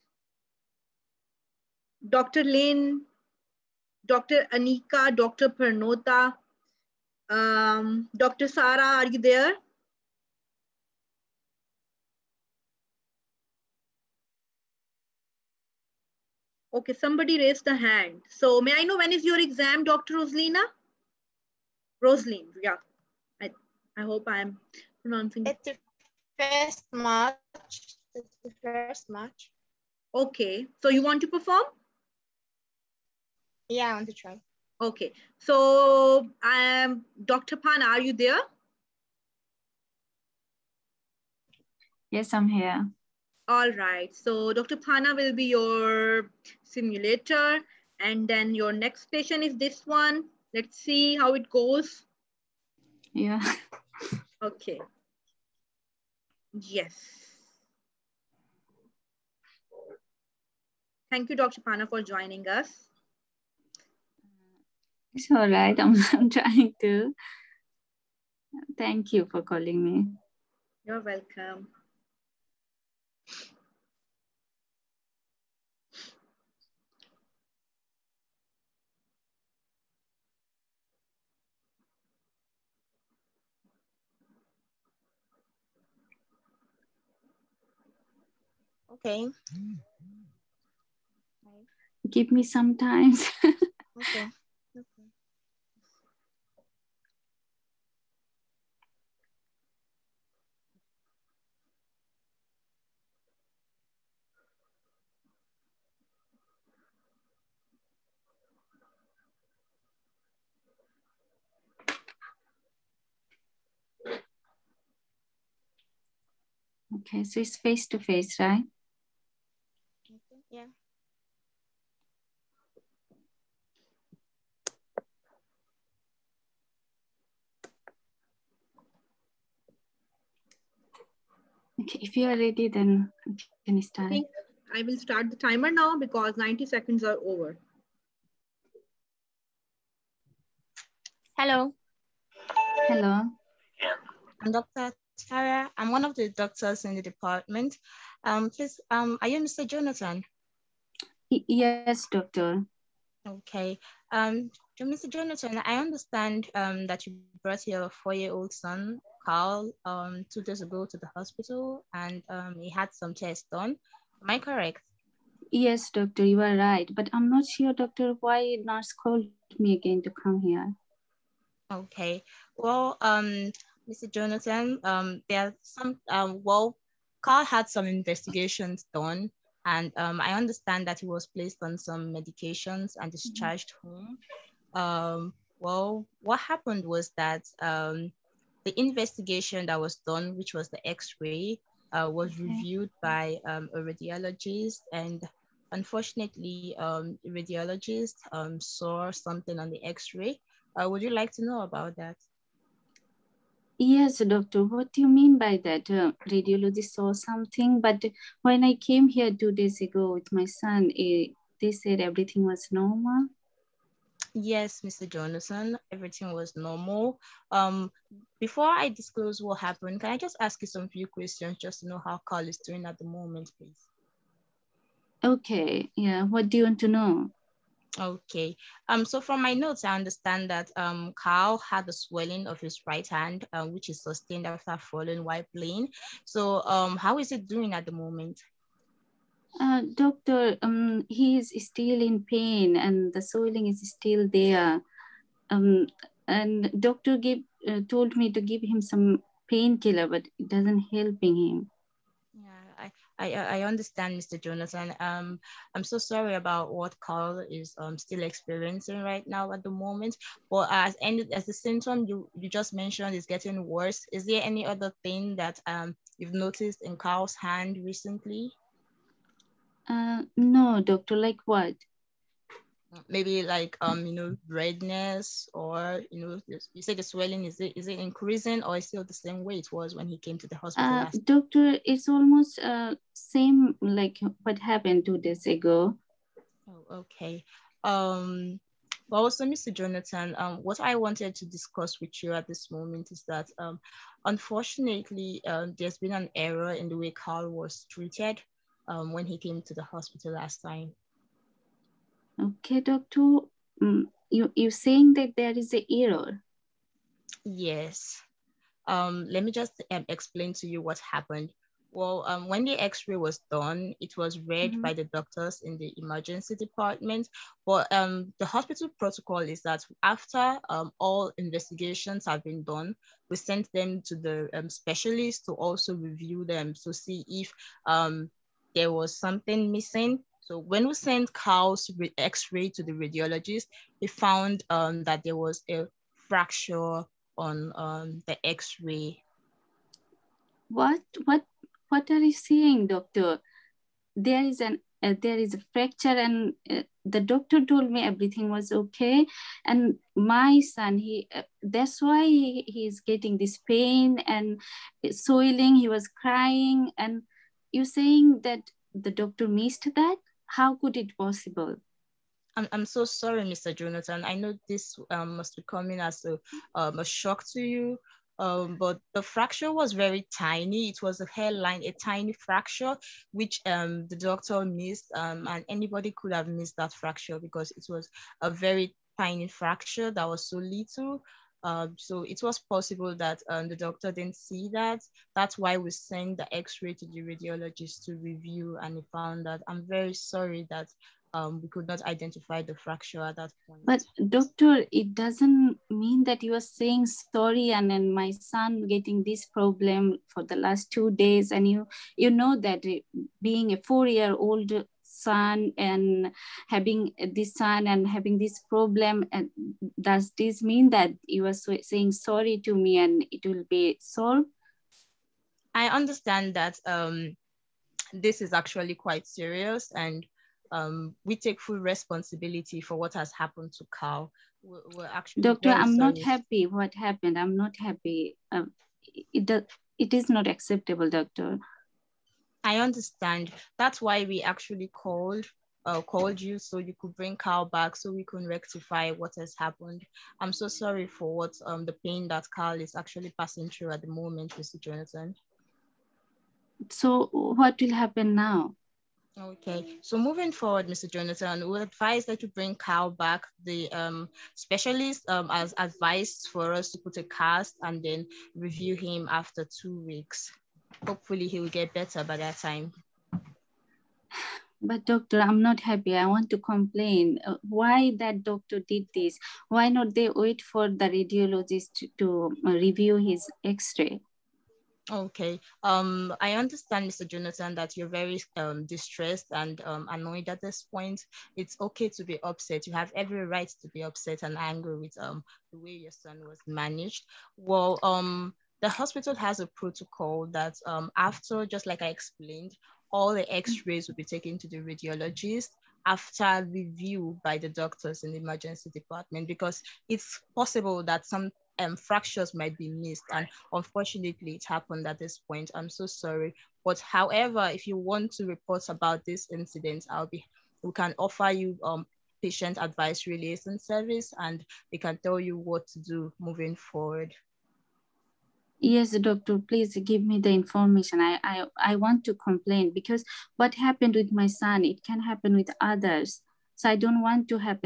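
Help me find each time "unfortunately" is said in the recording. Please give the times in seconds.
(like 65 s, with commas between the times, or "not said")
195 s, 294 s, 503 s.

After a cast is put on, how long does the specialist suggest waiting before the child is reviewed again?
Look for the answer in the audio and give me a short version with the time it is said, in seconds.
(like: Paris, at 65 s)
2 weeks, at 459 s.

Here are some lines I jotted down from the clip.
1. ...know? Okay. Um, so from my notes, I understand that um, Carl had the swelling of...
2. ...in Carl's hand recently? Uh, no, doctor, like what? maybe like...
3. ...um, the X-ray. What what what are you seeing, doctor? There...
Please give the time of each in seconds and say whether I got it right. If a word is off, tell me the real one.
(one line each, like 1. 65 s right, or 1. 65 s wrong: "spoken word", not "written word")
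1. 226 s right
2. 266 s right
3. 337 s right.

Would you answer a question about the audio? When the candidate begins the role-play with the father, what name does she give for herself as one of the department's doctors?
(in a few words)
Dr. Tara.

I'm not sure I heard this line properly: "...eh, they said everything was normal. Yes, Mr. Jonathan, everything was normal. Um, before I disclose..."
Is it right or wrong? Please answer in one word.
right.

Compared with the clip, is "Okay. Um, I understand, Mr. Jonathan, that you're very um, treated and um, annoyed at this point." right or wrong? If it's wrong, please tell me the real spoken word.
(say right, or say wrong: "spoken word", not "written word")
wrong: "distressed", not "treated".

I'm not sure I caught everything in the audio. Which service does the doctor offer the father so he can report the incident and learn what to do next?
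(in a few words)
Patient Advice Liaison Service.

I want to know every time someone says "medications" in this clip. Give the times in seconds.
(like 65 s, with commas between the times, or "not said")
182 s.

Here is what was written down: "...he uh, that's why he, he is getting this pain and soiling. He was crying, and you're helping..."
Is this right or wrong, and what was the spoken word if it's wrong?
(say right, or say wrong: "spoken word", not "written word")
wrong: "saying", not "helping".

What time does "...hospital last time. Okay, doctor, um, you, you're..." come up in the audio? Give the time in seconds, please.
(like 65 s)
299 s.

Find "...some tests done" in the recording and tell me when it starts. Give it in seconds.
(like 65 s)
162 s.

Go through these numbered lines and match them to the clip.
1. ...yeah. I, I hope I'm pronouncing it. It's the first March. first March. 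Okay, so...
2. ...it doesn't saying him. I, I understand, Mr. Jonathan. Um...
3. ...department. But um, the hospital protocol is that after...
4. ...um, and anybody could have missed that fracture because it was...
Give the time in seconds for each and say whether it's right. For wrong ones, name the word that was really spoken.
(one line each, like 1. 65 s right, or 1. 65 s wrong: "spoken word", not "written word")
1. 22 s right
2. 250 s wrong: "helping", not "saying"
3. 316 s right
4. 375 s right.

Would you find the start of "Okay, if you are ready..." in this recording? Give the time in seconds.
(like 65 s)
131 s.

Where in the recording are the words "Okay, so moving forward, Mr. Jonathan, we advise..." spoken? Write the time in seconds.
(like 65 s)
449 s.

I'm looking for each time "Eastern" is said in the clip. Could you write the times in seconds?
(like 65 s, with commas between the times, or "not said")
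not said.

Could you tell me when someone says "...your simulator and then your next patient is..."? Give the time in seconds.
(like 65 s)
45 s.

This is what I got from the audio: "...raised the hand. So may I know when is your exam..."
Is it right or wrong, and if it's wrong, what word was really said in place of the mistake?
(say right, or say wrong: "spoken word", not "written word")
right.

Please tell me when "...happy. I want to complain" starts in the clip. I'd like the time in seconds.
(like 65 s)
465 s.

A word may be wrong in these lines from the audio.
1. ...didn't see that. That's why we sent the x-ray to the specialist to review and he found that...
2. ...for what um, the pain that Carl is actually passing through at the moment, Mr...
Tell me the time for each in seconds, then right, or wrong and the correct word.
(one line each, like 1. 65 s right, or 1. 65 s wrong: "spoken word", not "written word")
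1. 384 s wrong: "radiologist", not "specialist"
2. 441 s right.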